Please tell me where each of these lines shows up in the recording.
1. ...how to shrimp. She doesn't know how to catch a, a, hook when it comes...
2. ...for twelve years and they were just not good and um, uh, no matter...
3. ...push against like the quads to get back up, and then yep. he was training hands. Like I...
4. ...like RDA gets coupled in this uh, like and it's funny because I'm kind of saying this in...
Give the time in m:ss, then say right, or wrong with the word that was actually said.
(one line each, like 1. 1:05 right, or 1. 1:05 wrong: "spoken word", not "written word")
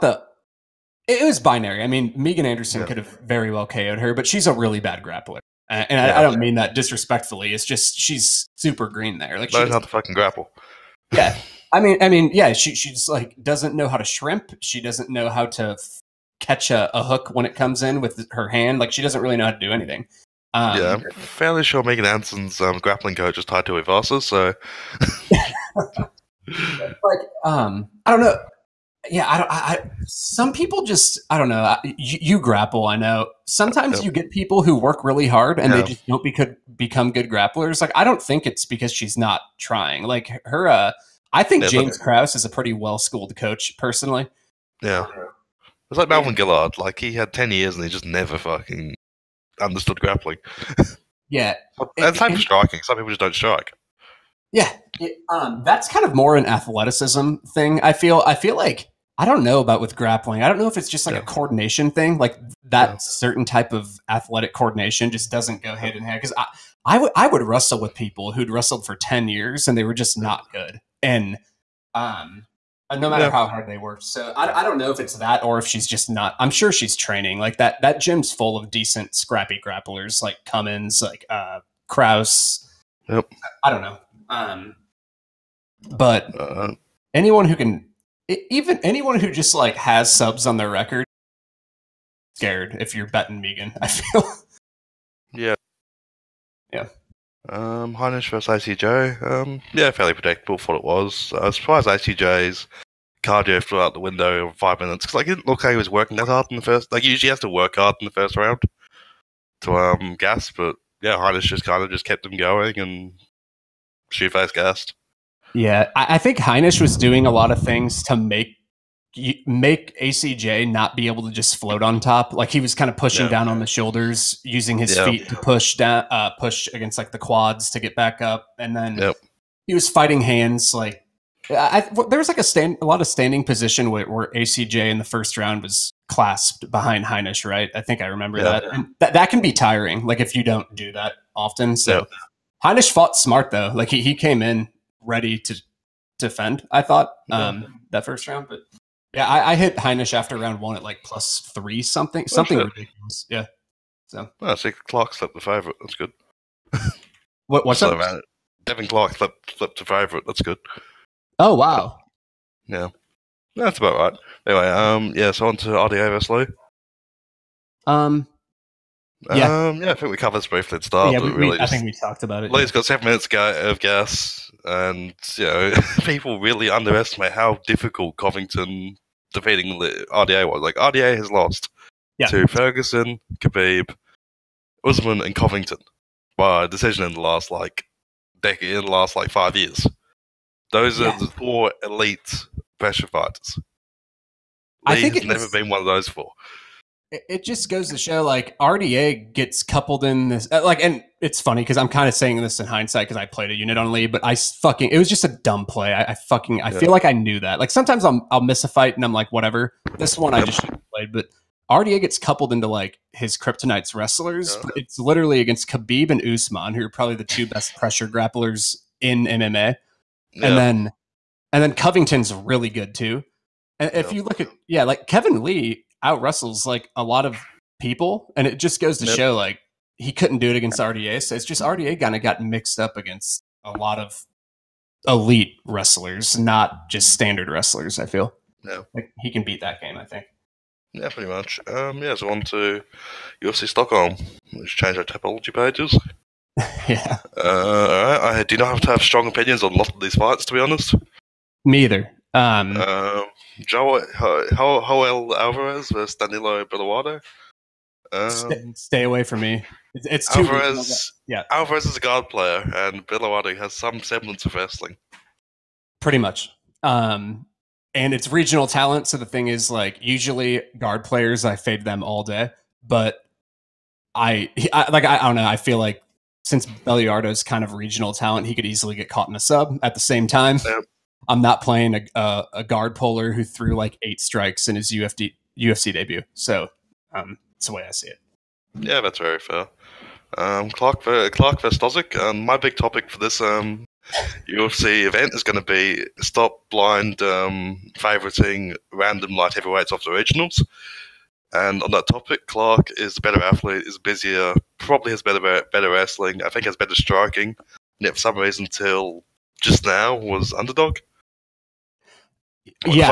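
1. 0:13 right
2. 1:08 wrong: "ten", not "twelve"
3. 2:06 wrong: "fighting", not "training"
4. 3:18 right.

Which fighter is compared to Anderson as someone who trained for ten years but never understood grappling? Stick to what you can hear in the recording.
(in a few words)
Melvin Guillard.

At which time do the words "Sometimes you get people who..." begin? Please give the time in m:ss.
0:33.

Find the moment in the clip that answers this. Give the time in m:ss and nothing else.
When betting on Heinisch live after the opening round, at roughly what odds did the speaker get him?
2:31.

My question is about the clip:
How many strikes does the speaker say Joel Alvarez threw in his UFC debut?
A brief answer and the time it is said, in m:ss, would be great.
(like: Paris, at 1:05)
8, at 4:44.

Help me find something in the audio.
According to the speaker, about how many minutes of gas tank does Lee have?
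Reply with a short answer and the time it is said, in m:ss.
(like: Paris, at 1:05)
7 minutes, at 2:52.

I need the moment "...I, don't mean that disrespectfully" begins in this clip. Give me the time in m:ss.
0:06.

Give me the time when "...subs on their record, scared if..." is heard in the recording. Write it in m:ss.
1:30.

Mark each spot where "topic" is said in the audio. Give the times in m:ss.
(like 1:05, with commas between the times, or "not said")
4:52, 5:02.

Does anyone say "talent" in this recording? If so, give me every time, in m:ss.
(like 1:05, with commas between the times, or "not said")
4:28, 4:38.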